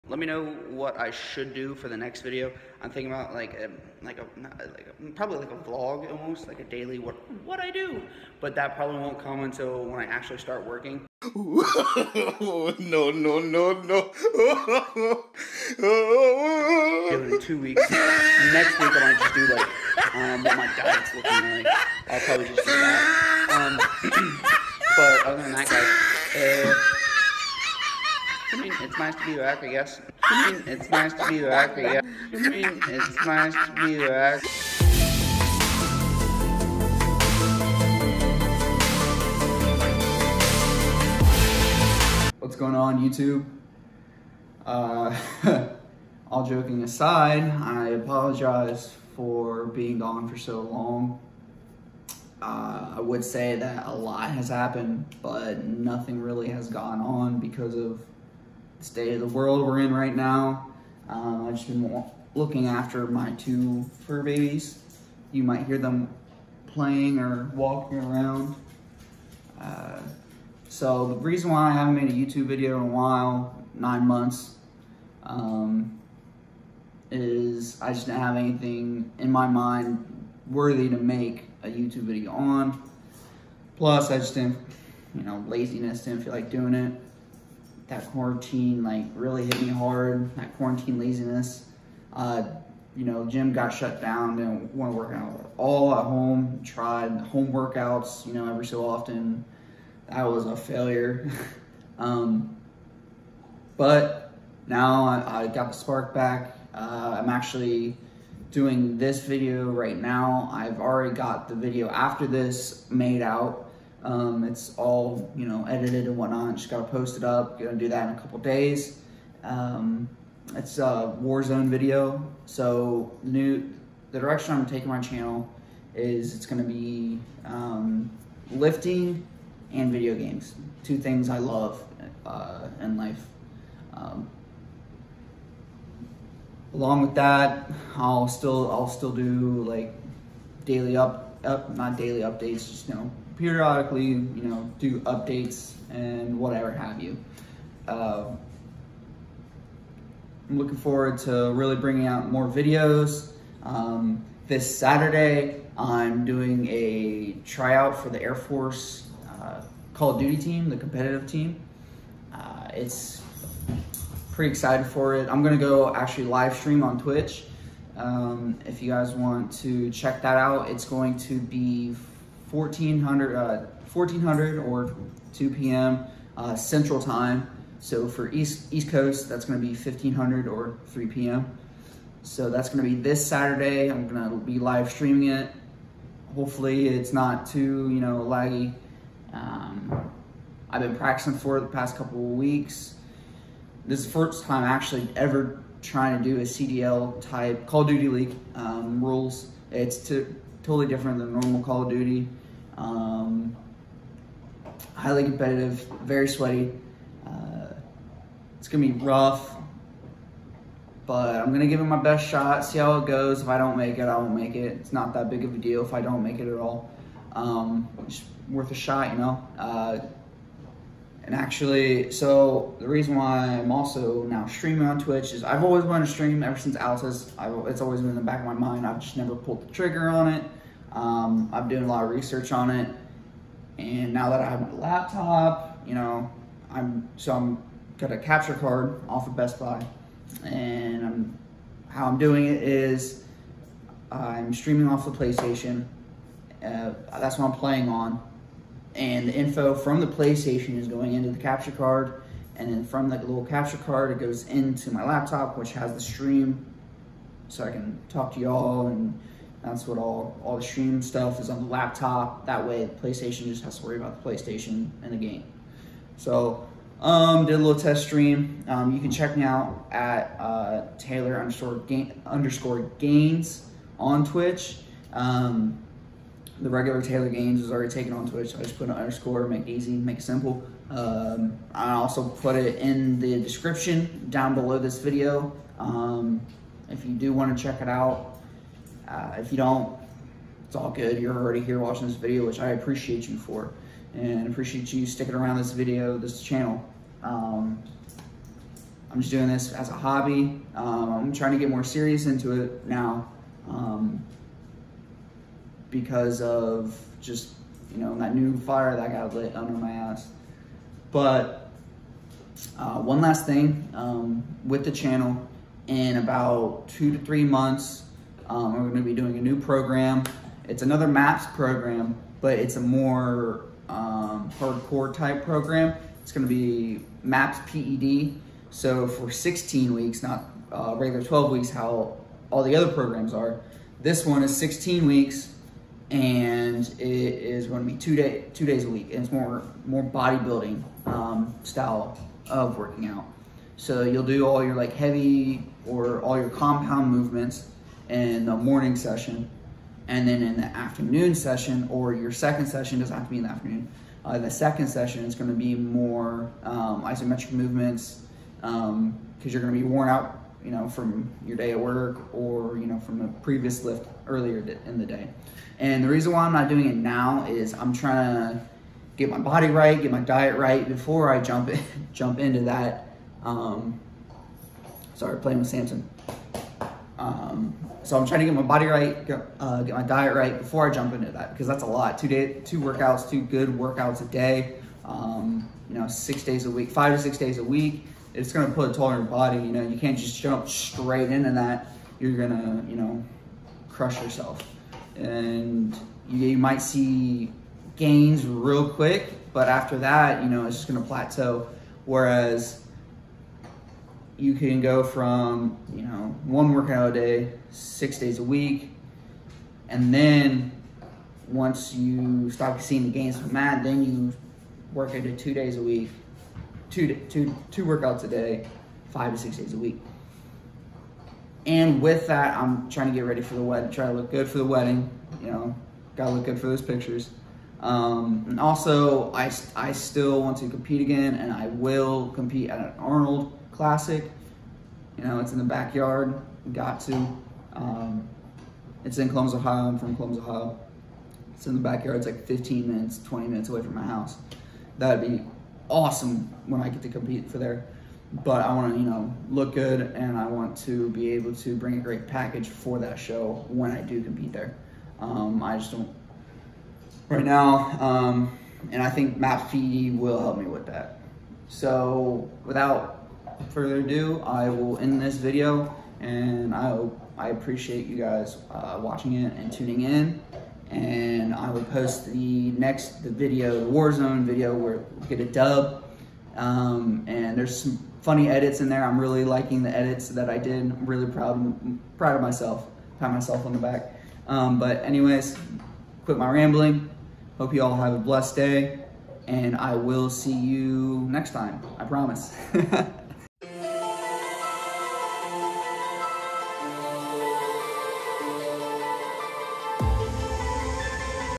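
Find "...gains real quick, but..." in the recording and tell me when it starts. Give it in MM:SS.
06:37.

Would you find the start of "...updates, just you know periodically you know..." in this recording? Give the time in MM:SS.
02:22.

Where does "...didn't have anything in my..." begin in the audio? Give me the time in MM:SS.
01:18.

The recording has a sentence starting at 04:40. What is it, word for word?
Um, I also put it in the description down below this video.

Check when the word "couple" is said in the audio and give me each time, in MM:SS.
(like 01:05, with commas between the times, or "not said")
01:58, 03:11.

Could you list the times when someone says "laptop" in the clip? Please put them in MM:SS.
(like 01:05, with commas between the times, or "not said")
03:54, 04:15, 04:21.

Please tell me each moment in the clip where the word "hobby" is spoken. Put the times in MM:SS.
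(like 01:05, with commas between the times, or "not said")
04:59.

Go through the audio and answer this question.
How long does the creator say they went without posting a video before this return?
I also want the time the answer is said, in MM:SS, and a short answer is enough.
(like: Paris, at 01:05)
9 months, at 01:13.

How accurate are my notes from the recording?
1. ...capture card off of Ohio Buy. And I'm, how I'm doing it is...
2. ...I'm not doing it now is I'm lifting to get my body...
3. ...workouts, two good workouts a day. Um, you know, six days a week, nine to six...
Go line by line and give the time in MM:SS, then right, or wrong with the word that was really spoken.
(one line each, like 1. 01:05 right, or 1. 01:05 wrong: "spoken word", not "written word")
1. 03:58 wrong: "Best", not "Ohio"
2. 06:06 wrong: "trying", not "lifting"
3. 06:22 wrong: "five", not "nine".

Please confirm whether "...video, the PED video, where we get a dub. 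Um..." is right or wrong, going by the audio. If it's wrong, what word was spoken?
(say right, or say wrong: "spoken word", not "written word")
wrong: "Warzone", not "PED".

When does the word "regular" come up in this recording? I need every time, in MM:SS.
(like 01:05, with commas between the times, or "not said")
04:36, 05:30.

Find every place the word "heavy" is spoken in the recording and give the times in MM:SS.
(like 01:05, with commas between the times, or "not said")
05:44.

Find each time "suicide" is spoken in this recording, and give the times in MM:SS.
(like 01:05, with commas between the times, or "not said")
not said.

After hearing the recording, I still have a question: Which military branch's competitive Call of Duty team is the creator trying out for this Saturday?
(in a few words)
Air Force.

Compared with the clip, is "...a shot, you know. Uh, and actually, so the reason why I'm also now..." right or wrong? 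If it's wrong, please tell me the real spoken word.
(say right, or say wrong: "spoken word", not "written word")
right.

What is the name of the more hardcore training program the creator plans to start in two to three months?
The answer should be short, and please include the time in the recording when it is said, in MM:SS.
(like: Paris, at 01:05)
MAPS PED, at 05:27.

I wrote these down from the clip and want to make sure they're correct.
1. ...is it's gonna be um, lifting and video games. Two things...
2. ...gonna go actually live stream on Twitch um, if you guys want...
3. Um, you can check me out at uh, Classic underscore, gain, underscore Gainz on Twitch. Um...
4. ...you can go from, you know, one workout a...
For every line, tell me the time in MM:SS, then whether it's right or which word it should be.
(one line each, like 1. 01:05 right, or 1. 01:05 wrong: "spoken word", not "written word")
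1. 02:05 right
2. 02:45 right
3. 04:28 wrong: "Taylor", not "Classic"
4. 06:44 right.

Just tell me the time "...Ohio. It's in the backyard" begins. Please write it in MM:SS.
07:20.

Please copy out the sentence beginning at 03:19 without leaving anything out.
It's to, totally different than normal Call of Duty.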